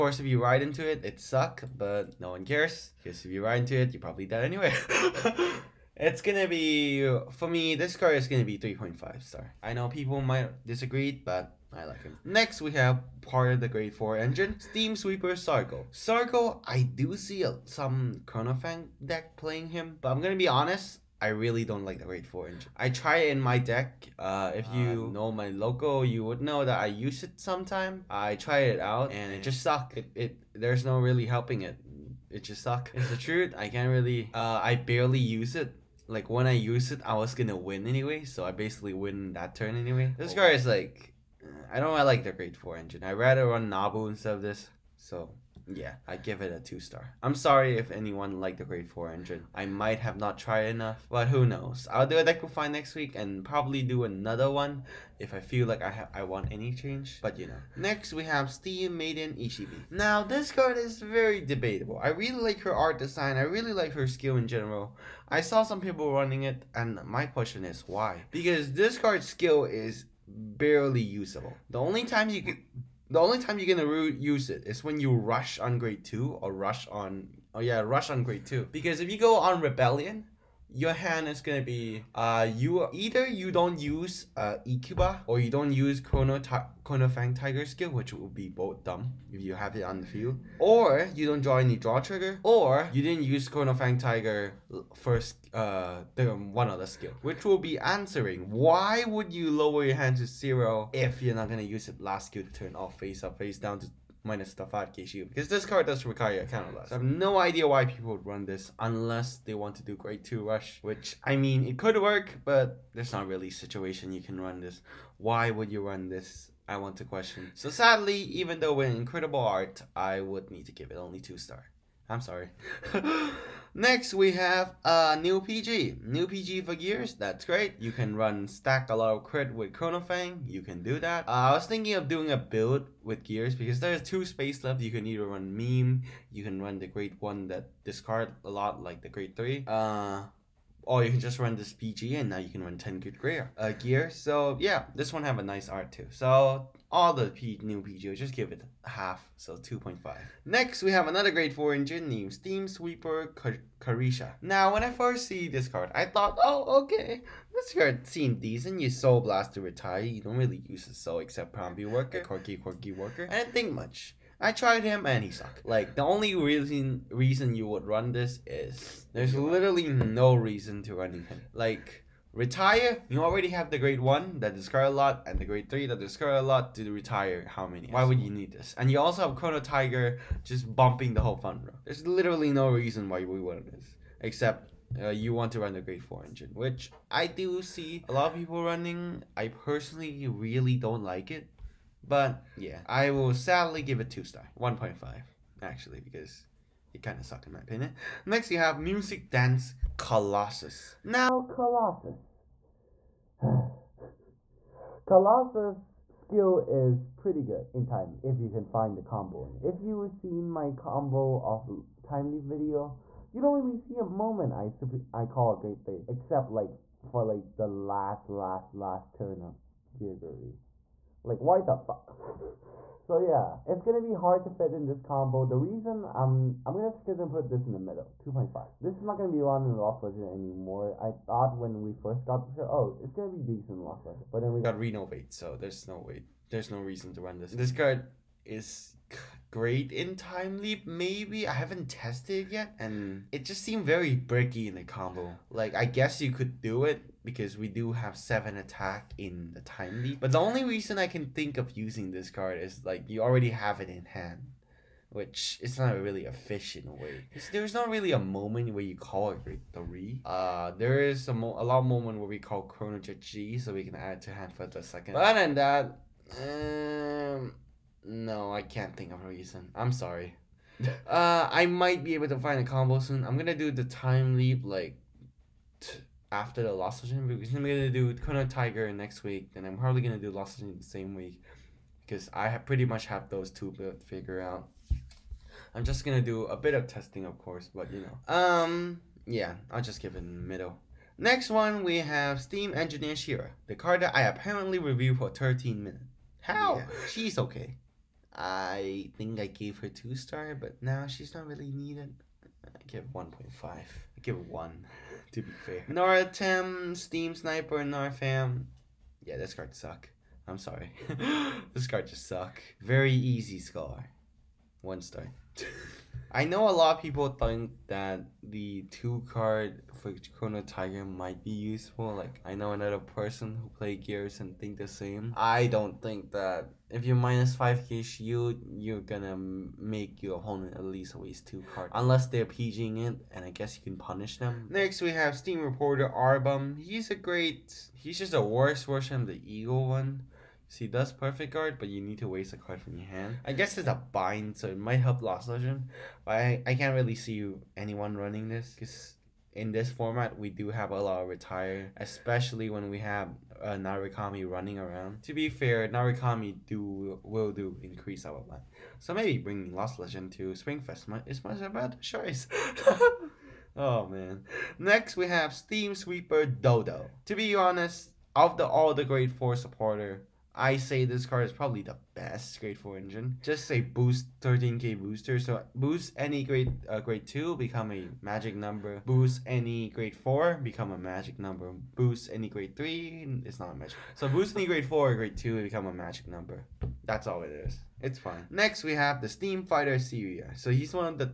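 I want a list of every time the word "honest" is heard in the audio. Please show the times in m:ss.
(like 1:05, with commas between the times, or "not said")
0:20, 6:07.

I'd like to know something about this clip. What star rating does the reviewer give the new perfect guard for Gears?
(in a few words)
2.5.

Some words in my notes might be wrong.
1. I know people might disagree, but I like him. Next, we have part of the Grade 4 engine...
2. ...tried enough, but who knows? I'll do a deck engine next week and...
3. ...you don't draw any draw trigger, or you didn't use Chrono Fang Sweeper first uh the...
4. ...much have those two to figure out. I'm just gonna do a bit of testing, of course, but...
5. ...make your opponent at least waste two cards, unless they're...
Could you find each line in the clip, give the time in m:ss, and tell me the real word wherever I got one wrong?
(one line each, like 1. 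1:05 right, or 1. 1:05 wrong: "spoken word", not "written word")
1. 0:09 right
2. 0:50 wrong: "refine", not "engine"
3. 1:31 wrong: "Tiger", not "Sweeper"
4. 4:42 right
5. 5:29 right.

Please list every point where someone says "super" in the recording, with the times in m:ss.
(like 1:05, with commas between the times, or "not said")
3:34.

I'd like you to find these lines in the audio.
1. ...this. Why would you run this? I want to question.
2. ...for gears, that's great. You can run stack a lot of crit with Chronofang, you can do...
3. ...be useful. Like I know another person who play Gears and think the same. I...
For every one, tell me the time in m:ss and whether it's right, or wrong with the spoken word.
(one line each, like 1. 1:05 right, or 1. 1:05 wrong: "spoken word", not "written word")
1. 1:54 right
2. 2:06 right
3. 5:21 right.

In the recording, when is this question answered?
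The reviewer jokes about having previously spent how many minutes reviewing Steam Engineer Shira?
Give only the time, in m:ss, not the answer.
4:55.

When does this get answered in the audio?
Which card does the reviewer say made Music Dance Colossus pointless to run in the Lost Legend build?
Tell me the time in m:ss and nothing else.
3:54.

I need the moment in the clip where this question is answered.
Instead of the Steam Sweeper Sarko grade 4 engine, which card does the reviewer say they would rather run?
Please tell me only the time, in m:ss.
0:43.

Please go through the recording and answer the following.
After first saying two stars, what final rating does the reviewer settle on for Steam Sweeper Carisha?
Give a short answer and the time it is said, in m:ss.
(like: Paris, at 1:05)
1.5, at 3:14.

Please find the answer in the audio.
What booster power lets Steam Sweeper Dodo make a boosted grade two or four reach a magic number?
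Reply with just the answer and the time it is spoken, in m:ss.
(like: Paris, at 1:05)
13k, at 6:14.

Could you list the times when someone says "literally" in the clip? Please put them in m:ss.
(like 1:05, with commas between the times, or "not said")
2:49, 3:02.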